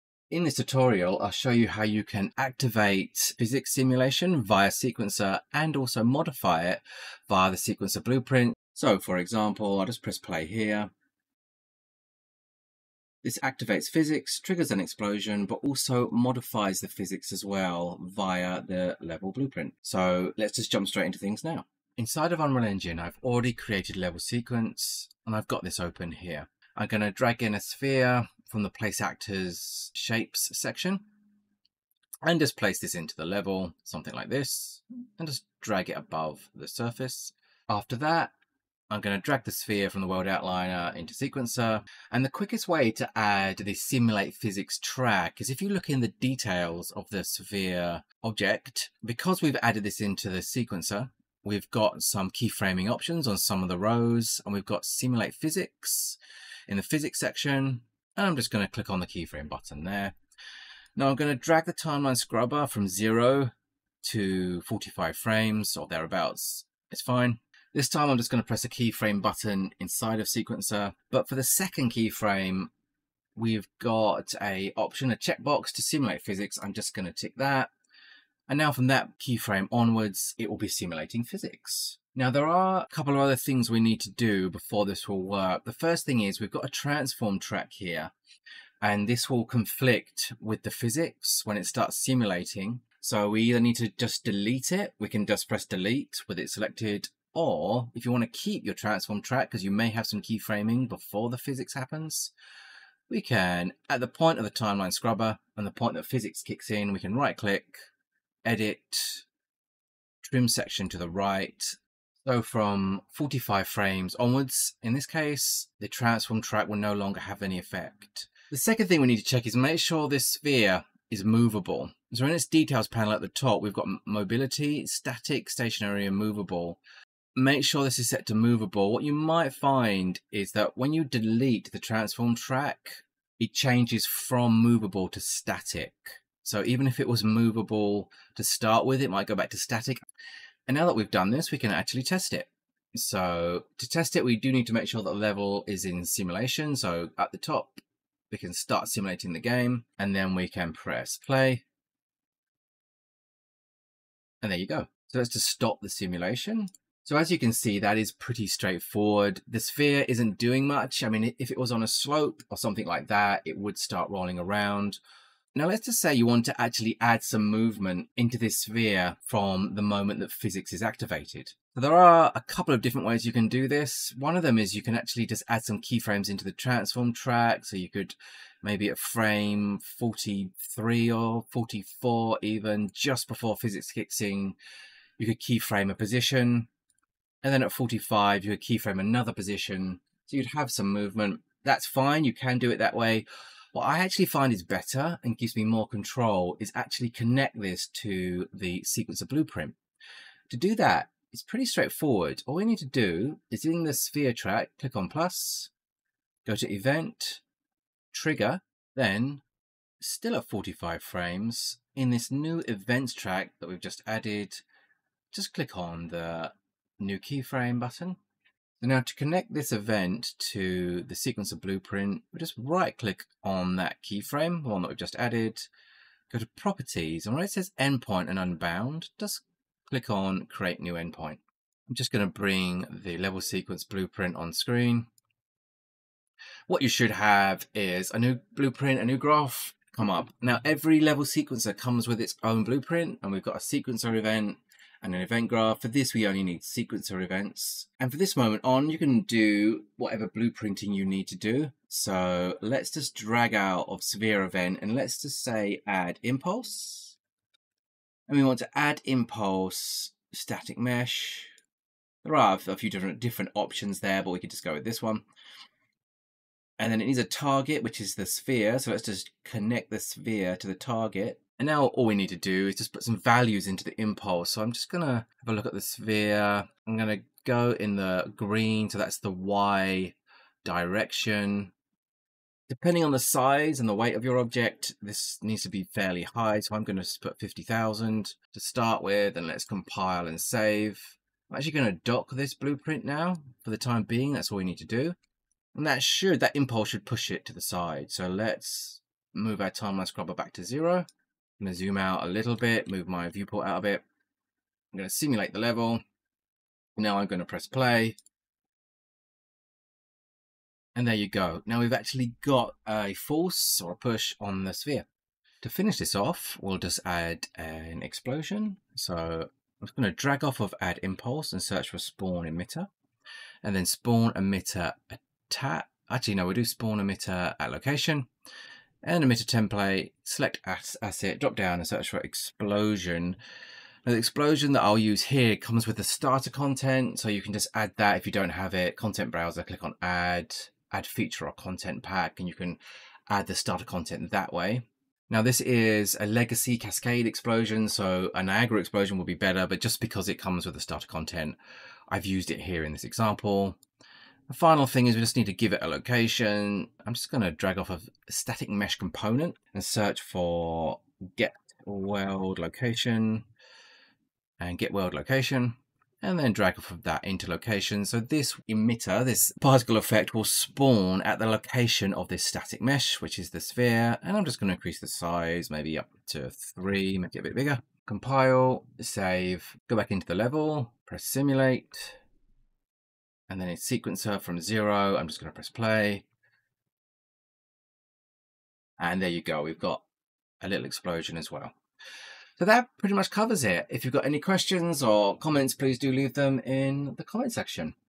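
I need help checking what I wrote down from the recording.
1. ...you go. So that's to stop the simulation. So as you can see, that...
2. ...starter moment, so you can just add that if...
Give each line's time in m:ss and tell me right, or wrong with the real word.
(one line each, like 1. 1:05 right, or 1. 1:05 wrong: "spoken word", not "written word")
1. 2:34 right
2. 5:36 wrong: "content", not "moment".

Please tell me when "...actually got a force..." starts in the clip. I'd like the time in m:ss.
5:11.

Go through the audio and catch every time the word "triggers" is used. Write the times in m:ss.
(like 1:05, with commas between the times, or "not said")
0:14, 3:28.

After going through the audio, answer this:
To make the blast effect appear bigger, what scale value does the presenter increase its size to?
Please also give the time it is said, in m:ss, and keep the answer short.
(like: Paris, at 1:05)
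3, at 6:16.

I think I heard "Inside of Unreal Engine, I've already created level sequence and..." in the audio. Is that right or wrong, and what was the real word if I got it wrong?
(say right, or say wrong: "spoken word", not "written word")
right.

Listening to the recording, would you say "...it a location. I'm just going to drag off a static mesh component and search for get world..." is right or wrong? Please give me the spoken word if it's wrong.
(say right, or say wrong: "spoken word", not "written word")
right.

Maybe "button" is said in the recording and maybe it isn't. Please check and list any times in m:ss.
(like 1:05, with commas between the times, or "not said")
0:59, 1:09, 3:37.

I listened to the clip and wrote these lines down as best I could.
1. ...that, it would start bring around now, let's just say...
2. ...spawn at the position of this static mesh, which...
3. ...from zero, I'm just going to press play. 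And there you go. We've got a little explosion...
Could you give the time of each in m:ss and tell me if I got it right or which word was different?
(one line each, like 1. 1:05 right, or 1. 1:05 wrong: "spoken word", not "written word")
1. 2:43 wrong: "rolling", not "bring"
2. 6:10 wrong: "location", not "position"
3. 6:24 right.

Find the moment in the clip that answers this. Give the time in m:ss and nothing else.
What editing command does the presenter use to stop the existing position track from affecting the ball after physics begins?
1:50.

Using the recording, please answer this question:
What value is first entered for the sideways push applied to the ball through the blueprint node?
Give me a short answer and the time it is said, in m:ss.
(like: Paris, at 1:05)
50,000, at 4:47.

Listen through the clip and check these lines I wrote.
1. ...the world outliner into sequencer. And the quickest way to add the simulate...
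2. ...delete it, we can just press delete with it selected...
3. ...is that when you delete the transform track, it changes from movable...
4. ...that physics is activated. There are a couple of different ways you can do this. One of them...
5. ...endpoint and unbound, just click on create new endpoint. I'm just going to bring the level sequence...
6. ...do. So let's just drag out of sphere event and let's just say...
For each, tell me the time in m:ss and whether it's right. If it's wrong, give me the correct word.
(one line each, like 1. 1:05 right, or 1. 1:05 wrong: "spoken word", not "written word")
1. 0:40 right
2. 1:34 right
3. 2:10 right
4. 2:50 right
5. 3:47 right
6. 4:11 wrong: "severe", not "sphere".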